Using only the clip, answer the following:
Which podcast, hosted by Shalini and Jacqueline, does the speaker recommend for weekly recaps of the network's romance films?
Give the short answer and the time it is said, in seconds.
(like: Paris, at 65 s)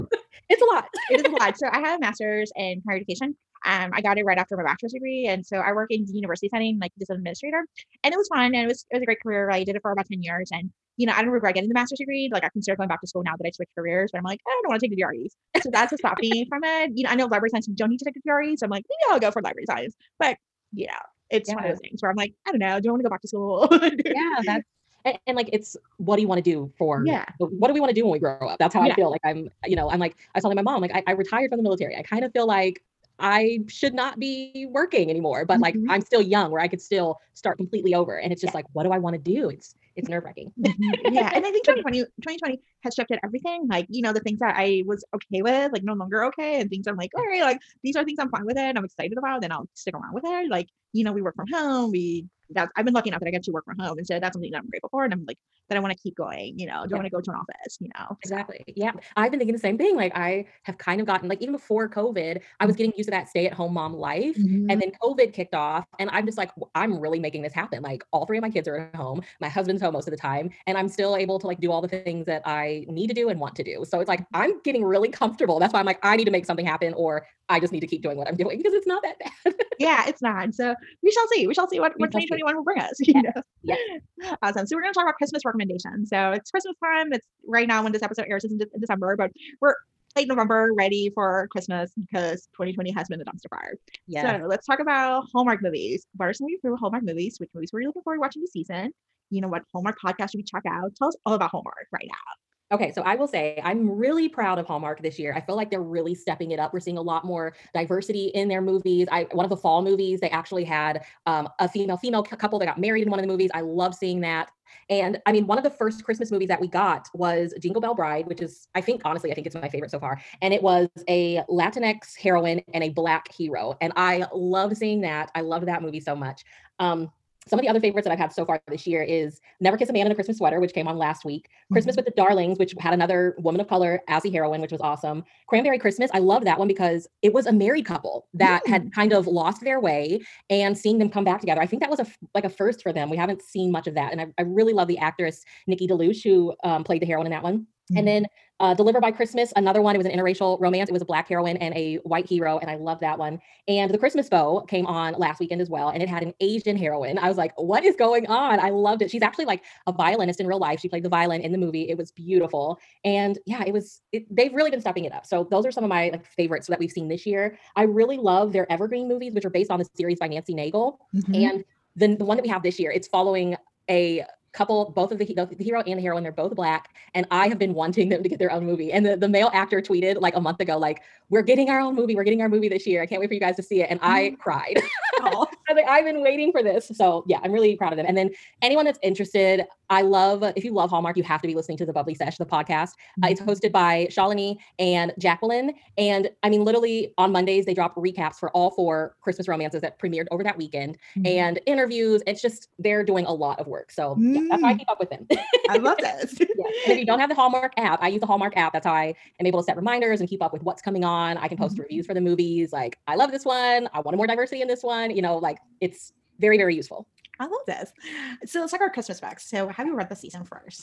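Bubbly Sesh, at 191 s.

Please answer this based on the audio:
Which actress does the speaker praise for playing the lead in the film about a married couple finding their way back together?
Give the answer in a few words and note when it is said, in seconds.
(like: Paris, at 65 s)
Nikki DeLoach, at 145 s.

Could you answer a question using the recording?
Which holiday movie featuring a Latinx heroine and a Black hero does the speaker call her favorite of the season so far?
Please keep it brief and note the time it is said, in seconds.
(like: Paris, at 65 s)
Jingle Bell Bride, at 117 s.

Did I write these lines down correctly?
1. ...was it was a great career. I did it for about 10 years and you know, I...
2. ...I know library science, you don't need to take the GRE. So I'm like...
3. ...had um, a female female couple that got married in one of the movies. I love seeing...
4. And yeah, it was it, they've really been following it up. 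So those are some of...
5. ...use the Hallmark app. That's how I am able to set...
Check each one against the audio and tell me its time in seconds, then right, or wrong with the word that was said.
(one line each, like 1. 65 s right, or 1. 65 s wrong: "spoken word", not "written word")
1. 8 s right
2. 17 s right
3. 110 s right
4. 163 s wrong: "stepping", not "following"
5. 208 s right.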